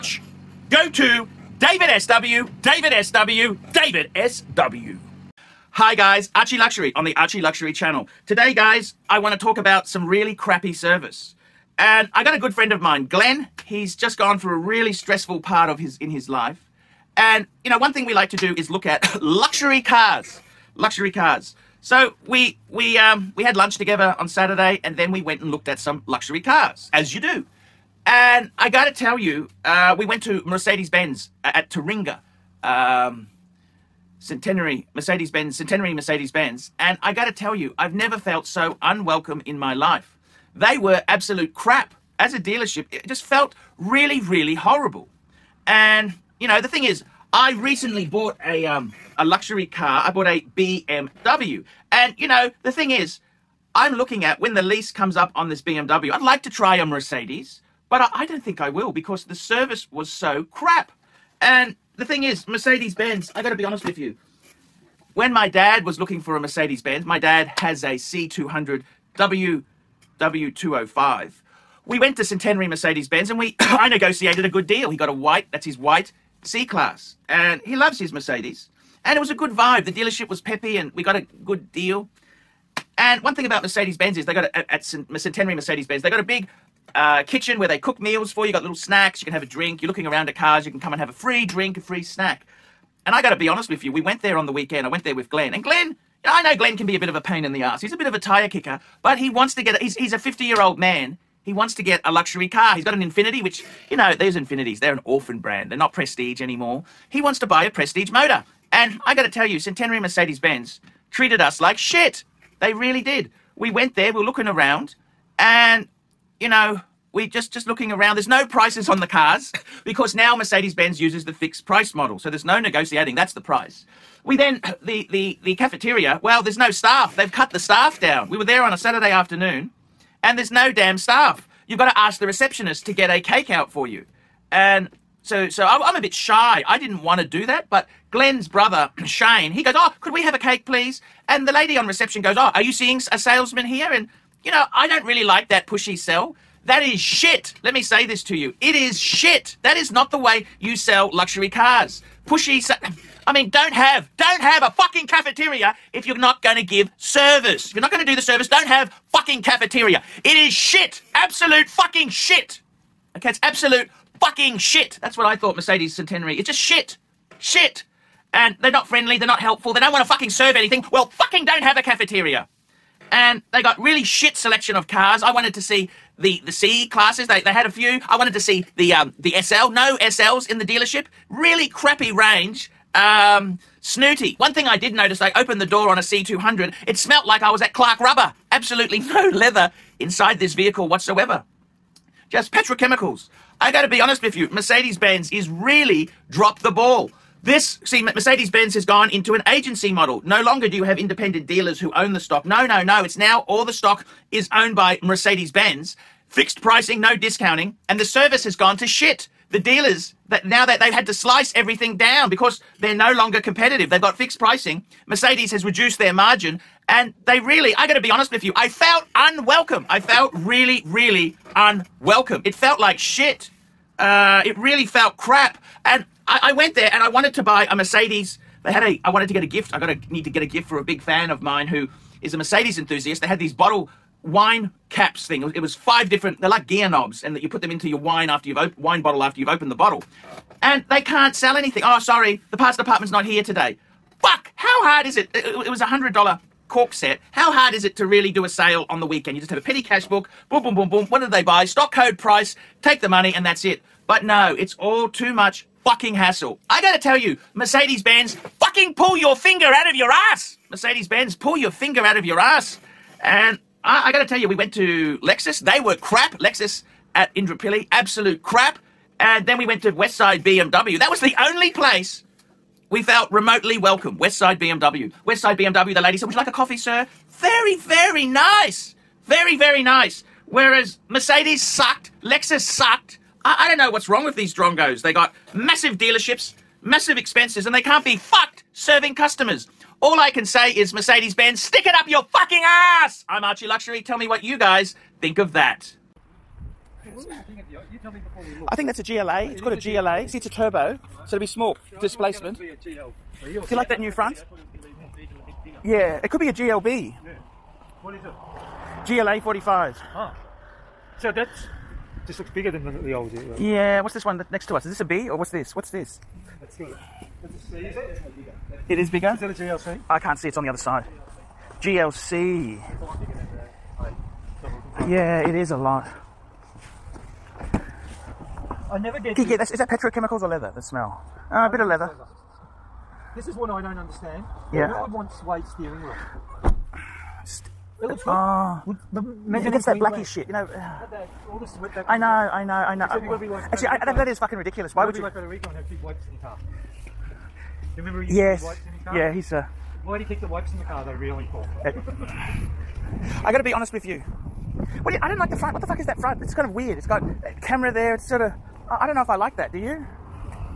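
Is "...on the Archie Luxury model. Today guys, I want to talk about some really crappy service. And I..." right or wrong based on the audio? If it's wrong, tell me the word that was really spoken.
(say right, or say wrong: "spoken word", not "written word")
wrong: "channel", not "model".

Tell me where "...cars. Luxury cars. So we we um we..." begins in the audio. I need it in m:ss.
0:19.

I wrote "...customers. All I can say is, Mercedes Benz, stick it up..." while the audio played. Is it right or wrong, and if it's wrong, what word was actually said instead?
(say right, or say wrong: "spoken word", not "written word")
right.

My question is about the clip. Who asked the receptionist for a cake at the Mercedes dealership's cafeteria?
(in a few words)
Shane.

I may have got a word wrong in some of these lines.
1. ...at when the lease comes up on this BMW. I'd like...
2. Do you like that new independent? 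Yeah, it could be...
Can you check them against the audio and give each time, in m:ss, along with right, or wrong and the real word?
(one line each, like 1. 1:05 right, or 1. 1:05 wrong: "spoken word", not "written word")
1. 0:54 right
2. 5:02 wrong: "front", not "independent".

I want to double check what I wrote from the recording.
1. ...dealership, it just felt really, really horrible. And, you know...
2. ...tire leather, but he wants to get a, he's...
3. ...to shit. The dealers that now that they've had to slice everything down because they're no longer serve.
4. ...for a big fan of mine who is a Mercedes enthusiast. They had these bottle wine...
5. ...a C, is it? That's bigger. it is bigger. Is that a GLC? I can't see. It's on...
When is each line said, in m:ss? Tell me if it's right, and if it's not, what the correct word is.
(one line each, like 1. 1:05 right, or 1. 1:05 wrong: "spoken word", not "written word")
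1. 0:42 right
2. 1:38 wrong: "kicker", not "leather"
3. 3:28 wrong: "competitive", not "serve"
4. 3:50 right
5. 5:17 right.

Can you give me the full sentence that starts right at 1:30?
You can come and have a free drink, a free snack.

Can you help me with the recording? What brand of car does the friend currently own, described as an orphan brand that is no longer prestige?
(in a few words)
Infiniti.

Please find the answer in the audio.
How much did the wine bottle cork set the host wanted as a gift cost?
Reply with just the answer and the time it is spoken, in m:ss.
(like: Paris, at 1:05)
$100, at 4:05.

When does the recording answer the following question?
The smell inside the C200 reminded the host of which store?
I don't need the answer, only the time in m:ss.
3:07.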